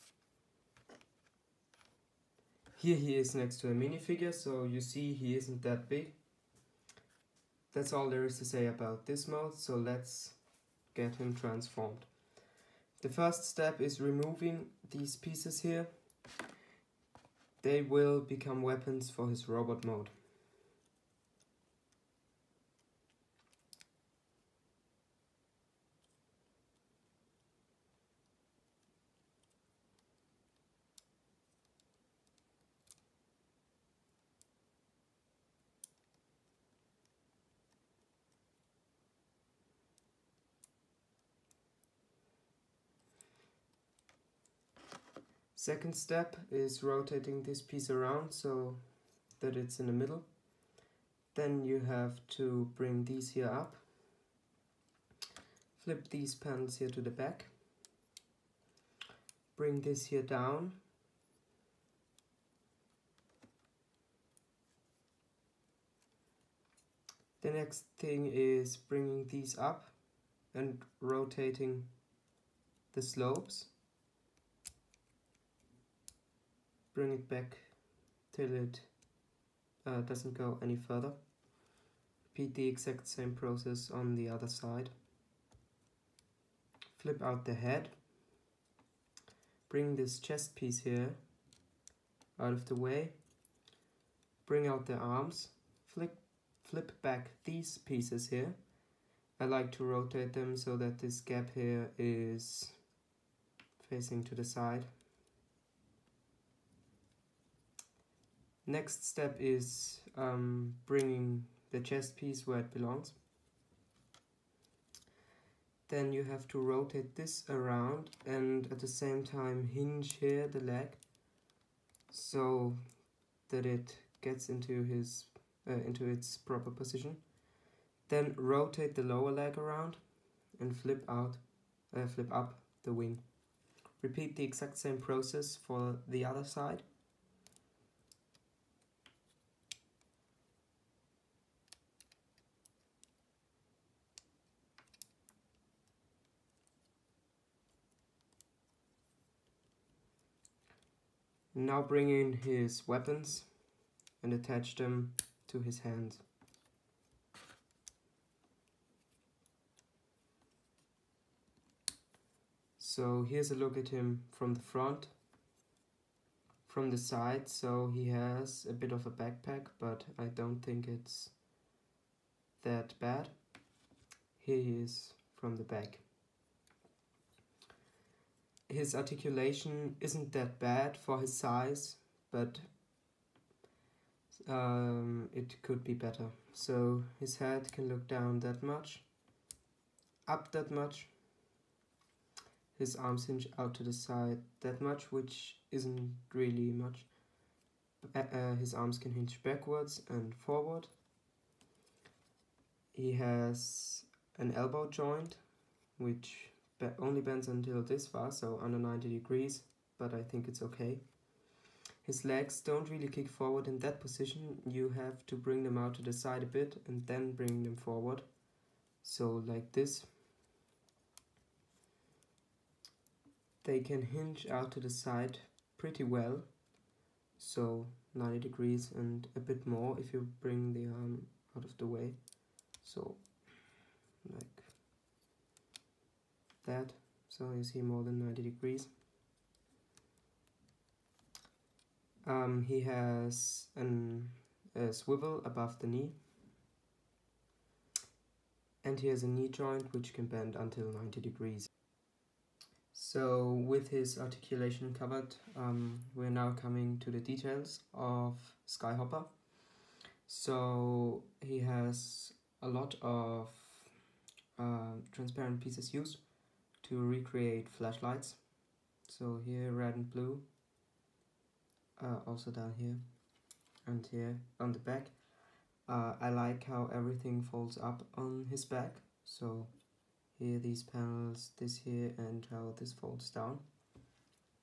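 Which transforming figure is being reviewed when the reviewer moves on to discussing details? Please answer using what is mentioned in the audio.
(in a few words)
Skyhopper.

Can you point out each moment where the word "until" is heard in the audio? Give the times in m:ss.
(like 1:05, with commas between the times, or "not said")
3:27, 4:10.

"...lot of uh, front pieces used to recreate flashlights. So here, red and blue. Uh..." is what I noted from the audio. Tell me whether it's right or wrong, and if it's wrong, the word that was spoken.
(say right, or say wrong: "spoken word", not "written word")
wrong: "transparent", not "front".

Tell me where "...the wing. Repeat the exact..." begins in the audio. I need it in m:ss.
2:12.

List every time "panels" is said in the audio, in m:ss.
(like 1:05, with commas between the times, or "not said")
0:56, 4:40.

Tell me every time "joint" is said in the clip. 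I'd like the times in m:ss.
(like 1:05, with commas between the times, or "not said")
3:24, 4:09.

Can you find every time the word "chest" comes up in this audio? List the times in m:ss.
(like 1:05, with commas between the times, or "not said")
1:30, 1:51.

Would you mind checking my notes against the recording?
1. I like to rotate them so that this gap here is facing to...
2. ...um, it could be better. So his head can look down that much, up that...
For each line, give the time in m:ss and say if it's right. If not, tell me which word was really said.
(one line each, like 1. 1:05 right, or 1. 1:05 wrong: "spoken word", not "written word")
1. 1:39 right
2. 3:04 right.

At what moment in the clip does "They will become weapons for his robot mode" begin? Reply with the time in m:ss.
0:17.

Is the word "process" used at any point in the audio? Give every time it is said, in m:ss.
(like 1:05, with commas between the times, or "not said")
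1:23, 2:14.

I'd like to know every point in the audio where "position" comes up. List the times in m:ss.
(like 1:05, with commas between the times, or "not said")
2:06, 3:34.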